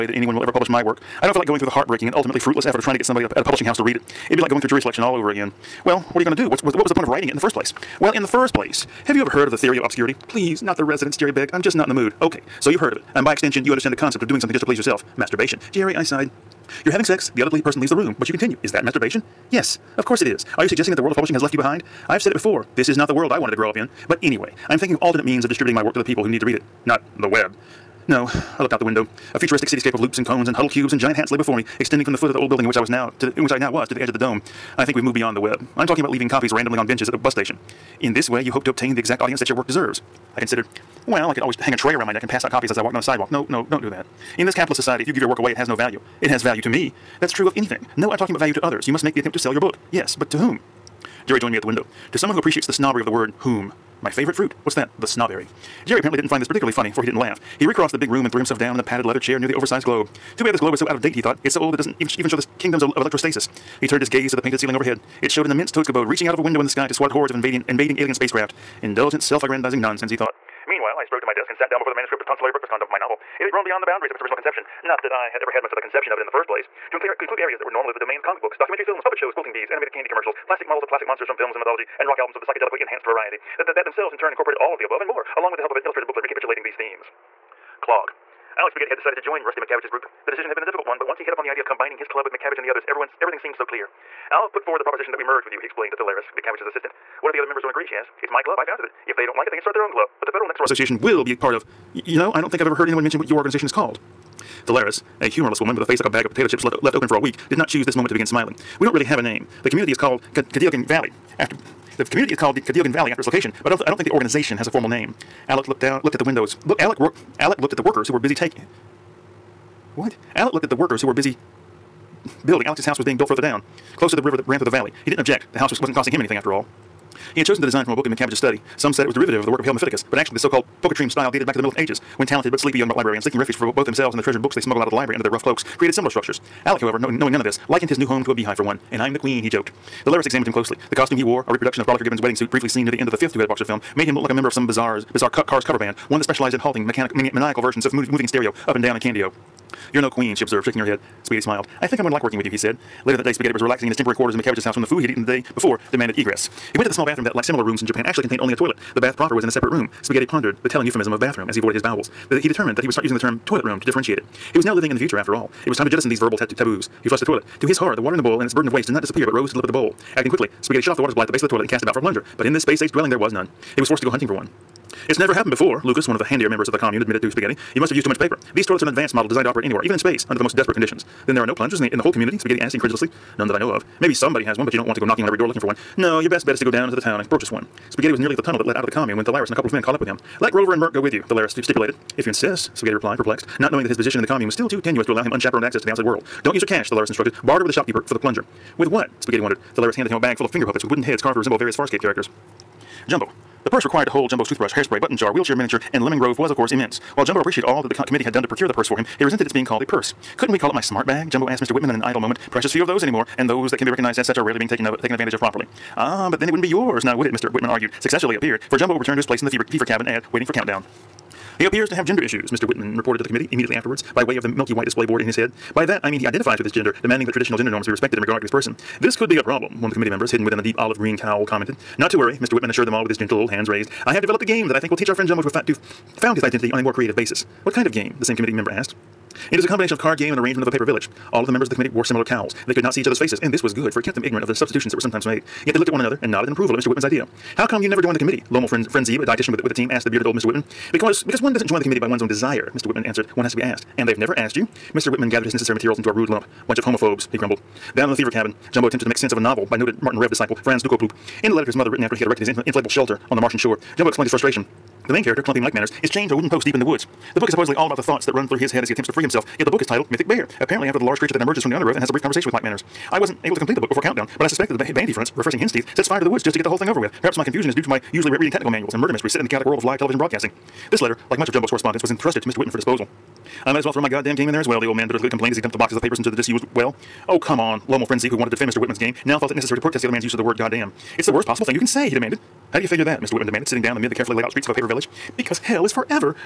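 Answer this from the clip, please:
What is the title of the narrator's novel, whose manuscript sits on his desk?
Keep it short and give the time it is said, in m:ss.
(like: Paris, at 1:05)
Tonsilary Breakfast Condom, at 1:12.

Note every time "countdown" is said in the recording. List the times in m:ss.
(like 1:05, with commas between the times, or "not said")
3:40, 4:34.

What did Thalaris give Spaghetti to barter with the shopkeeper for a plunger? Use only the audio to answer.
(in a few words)
finger puppets.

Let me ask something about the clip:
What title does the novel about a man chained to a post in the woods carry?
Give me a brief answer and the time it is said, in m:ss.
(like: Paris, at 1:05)
Mythic Bear, at 4:30.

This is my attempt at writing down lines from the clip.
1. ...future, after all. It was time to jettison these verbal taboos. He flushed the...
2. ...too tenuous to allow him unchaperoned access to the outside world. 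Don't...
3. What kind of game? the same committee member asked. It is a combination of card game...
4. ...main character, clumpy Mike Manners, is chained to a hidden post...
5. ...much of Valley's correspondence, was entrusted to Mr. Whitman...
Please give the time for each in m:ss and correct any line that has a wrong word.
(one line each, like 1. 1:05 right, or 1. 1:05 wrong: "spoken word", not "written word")
1. 2:44 right
2. 3:14 right
3. 3:57 right
4. 4:25 wrong: "wooden", not "hidden"
5. 4:41 wrong: "Jumbo", not "Valley".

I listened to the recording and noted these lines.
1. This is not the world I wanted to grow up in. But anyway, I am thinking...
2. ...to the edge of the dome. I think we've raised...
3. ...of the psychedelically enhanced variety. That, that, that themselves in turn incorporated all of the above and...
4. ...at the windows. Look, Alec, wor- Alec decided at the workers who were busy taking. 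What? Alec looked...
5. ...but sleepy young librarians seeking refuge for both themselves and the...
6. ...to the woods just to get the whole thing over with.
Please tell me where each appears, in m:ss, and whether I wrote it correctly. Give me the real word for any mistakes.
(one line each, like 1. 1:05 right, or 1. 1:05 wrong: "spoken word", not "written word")
1. 0:22 right
2. 0:33 wrong: "moved", not "raised"
3. 1:22 right
4. 1:56 wrong: "looked", not "decided"
5. 2:12 right
6. 4:36 right.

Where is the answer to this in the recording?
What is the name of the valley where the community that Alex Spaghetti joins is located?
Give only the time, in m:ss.
1:52.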